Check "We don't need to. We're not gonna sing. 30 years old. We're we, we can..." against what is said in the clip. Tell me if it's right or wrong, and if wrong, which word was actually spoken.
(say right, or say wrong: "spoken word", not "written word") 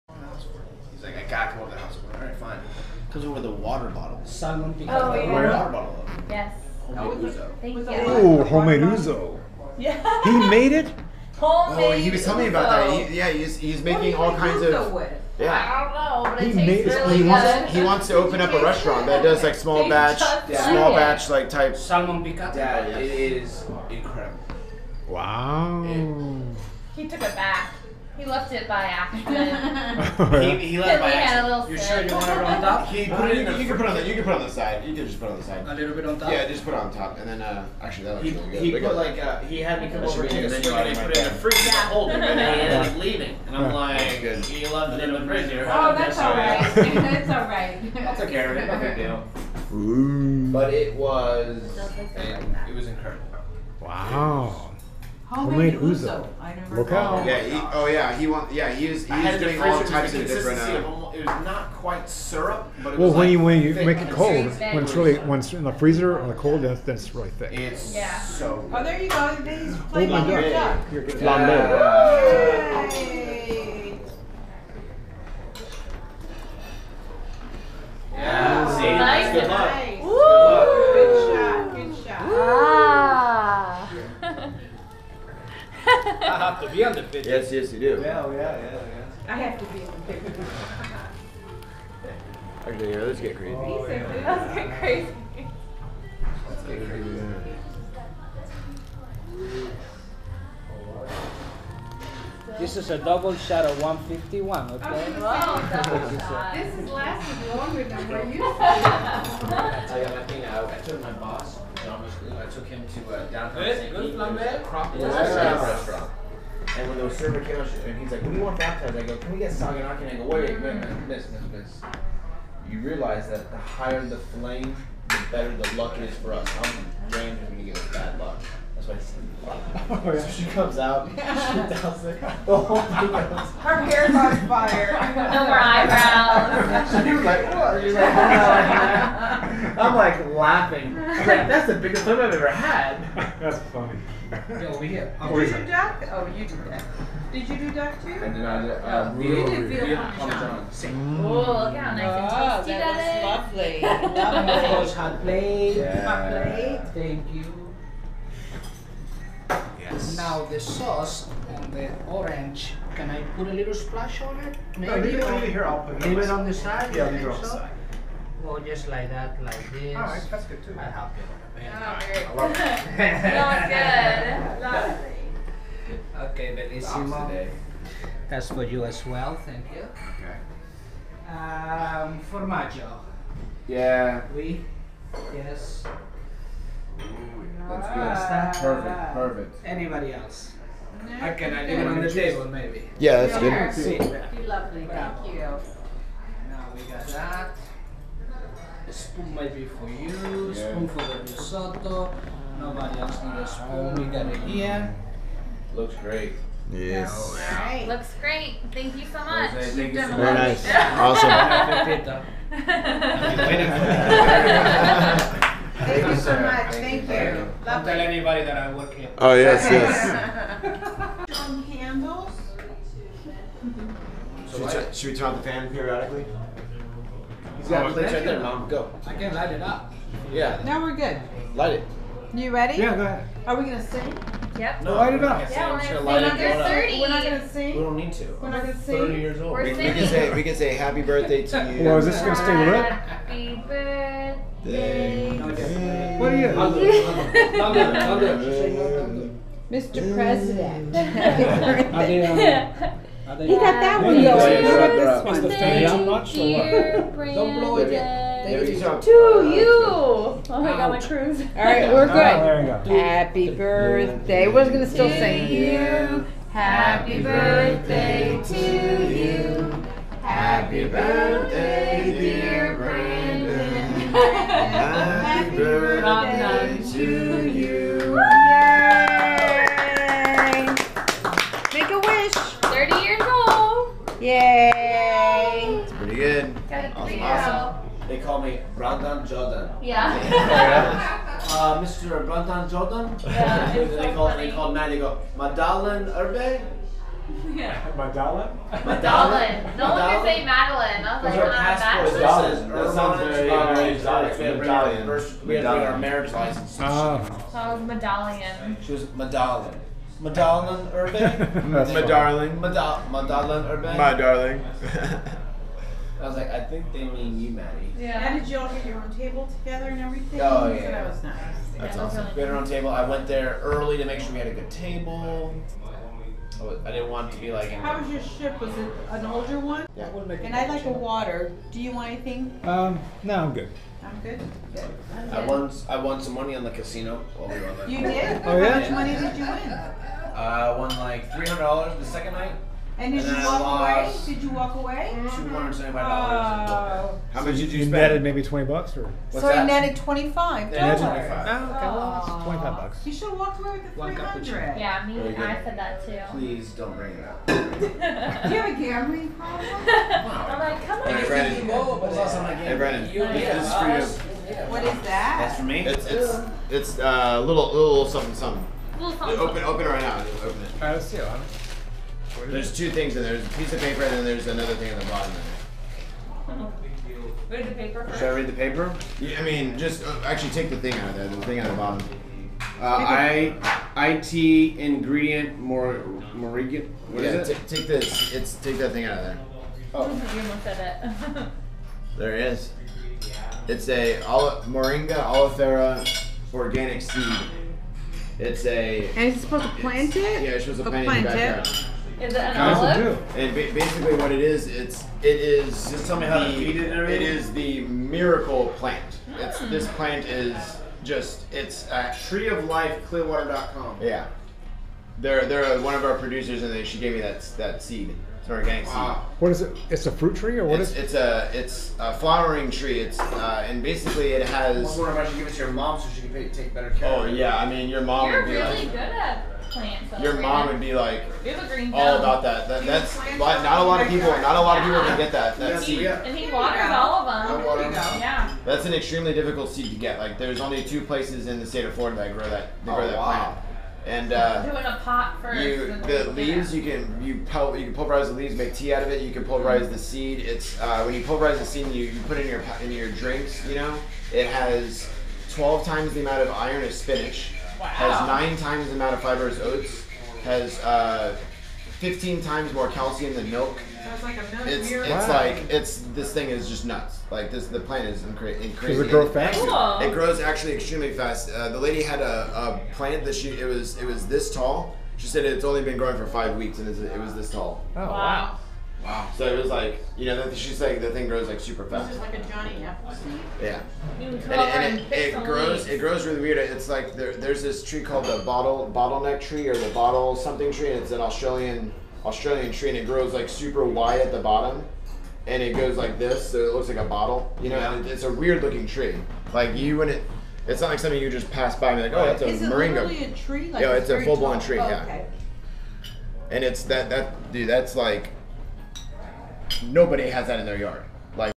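right.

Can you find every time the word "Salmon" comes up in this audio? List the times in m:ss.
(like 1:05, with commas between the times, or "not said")
0:04, 0:21.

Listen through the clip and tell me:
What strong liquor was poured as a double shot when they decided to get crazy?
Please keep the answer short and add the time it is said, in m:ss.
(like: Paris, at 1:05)
151, at 1:42.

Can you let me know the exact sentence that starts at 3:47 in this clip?
You got place right there, Mom.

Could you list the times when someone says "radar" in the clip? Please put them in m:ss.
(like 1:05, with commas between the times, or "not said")
not said.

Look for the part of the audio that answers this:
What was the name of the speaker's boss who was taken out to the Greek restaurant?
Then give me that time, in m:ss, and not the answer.
1:51.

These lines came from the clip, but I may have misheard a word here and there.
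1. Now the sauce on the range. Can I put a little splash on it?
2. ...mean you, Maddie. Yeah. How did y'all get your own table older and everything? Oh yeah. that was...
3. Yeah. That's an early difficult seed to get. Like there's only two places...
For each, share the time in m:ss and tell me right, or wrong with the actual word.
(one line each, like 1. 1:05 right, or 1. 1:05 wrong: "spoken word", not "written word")
1. 2:40 wrong: "orange", not "range"
2. 5:17 wrong: "together", not "older"
3. 7:18 wrong: "extremely", not "early".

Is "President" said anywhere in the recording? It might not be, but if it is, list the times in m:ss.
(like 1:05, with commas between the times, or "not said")
4:10.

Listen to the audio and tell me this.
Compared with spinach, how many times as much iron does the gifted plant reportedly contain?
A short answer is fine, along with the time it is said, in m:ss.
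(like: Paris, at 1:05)
12 times, at 7:35.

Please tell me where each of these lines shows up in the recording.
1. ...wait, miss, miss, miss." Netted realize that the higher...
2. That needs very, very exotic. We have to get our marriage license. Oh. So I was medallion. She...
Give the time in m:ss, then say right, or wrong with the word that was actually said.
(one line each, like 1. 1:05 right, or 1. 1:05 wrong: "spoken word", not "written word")
1. 2:00 wrong: "You", not "Netted"
2. 5:02 wrong: "sounds", not "needs".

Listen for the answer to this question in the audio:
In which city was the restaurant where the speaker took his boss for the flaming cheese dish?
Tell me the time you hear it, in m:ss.
1:53.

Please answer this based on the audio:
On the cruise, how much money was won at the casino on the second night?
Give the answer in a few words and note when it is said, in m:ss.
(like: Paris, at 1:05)
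$300, at 5:41.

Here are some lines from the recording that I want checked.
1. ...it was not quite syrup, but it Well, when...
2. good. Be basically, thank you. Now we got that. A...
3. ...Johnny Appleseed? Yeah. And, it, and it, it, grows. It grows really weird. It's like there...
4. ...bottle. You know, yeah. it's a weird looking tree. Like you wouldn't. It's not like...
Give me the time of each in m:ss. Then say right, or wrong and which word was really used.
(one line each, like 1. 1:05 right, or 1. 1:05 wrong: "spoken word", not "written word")
1. 1:01 right
2. 3:13 wrong: "lovely", not "basically"
3. 8:02 right
4. 8:17 right.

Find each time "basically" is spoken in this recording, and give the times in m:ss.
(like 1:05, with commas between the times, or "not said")
6:43, 7:03.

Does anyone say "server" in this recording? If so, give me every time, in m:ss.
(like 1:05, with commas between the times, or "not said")
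1:57.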